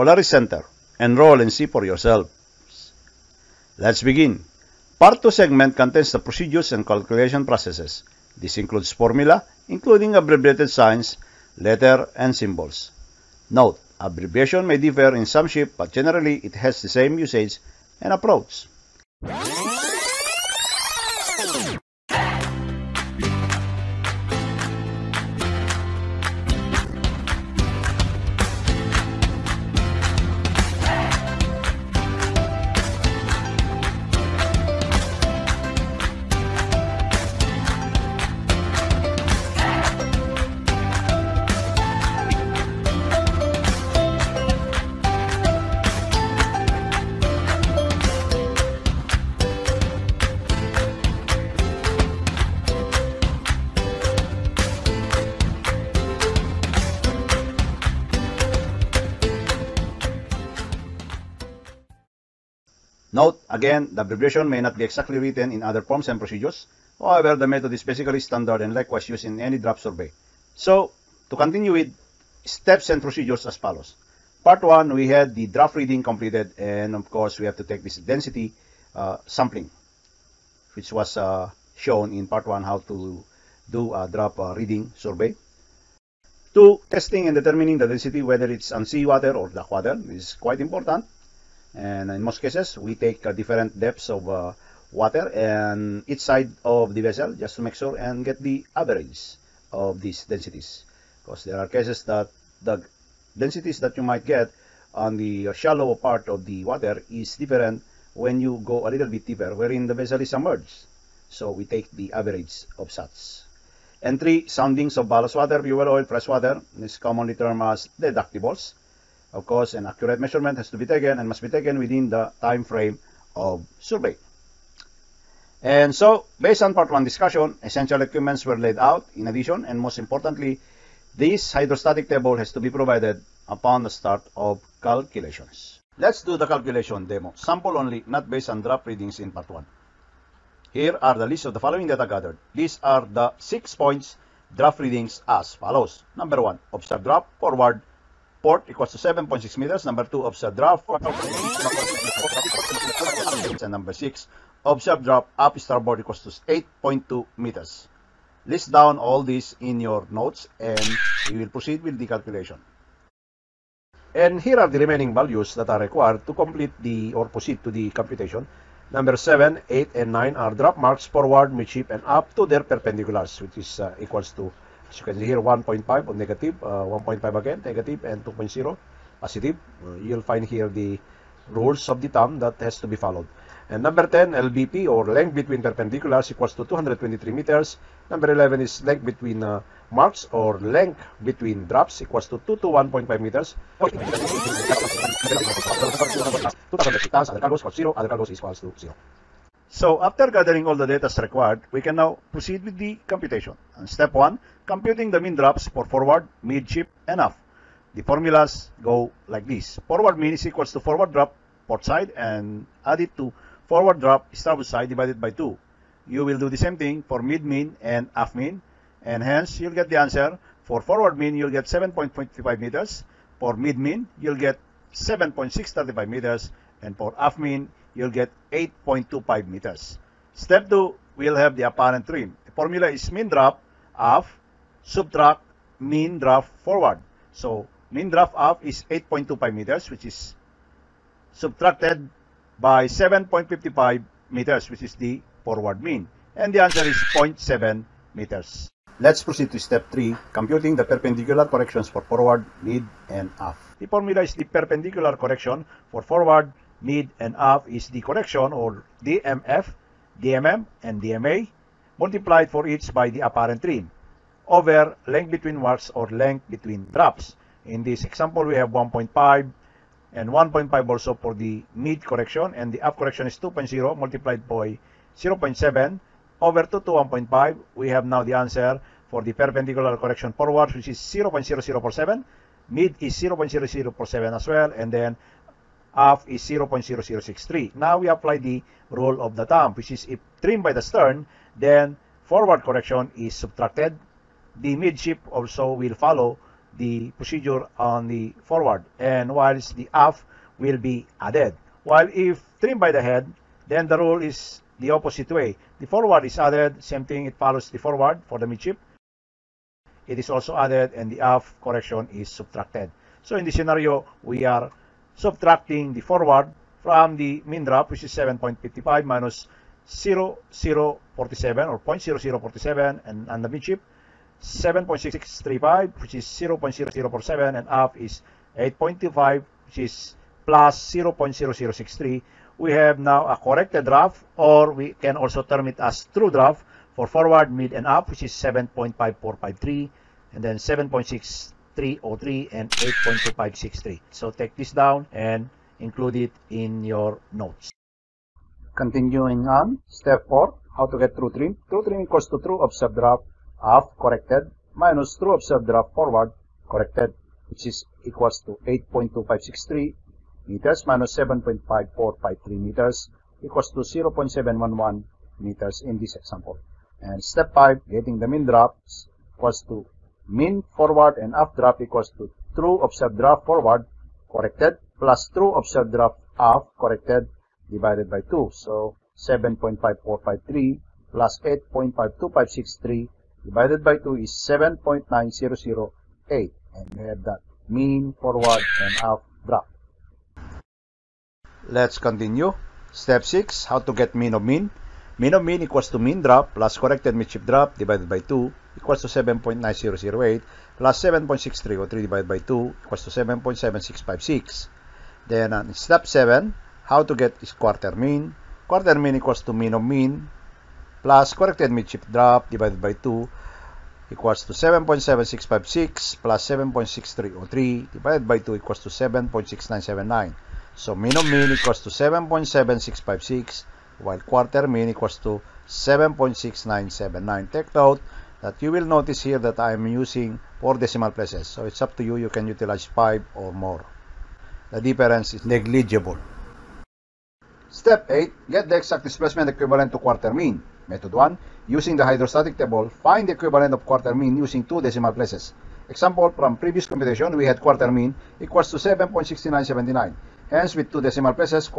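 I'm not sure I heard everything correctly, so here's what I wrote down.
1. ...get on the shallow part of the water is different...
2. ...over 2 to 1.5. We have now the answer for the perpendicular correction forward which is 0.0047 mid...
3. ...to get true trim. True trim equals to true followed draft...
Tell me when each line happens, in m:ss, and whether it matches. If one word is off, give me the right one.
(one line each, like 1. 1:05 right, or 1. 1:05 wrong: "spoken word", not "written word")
1. 1:44 right
2. 4:36 right
3. 5:50 wrong: "observed", not "followed".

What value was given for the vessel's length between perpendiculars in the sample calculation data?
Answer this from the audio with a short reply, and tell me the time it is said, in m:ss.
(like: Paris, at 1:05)
223 meters, at 3:06.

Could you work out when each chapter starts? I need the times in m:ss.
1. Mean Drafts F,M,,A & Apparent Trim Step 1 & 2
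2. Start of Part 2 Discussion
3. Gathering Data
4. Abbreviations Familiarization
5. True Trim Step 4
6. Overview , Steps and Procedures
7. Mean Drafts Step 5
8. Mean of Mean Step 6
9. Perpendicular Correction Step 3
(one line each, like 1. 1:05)
1. 3:19
2. 0:06
3. 2:15
4. 0:17
5. 5:47
6. 1:13
7. 6:06
8. 6:30
9. 4:08.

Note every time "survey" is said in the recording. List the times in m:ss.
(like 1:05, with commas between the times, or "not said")
1:09, 1:24, 2:03.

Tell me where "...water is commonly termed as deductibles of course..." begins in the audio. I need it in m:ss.
1:56.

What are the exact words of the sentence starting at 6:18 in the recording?
So 7.5453 plus 8.52563 divided by 2 is 7.9008.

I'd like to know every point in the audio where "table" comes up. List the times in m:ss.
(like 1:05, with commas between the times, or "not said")
2:12, 7:22.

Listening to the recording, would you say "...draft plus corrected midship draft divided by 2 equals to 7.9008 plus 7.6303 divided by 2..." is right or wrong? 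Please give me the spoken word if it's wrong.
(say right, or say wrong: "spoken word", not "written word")
right.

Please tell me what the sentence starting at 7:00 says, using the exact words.
So mean of mean equals to 7.7656 while quarter mean equals to 7.6979.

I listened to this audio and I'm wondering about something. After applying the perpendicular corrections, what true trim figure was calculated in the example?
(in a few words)
0.711 meters.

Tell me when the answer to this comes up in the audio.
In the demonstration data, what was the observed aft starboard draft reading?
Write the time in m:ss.
2:36.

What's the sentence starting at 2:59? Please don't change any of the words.
Uh, you'll find here the rules of the thumb that has to be followed.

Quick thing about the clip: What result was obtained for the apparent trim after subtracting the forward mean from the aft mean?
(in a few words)
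0.7 meters.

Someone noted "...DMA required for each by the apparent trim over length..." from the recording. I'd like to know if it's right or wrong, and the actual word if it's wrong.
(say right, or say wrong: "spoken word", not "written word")
wrong: "multiplied", not "required".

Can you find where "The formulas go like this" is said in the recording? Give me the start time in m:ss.
3:27.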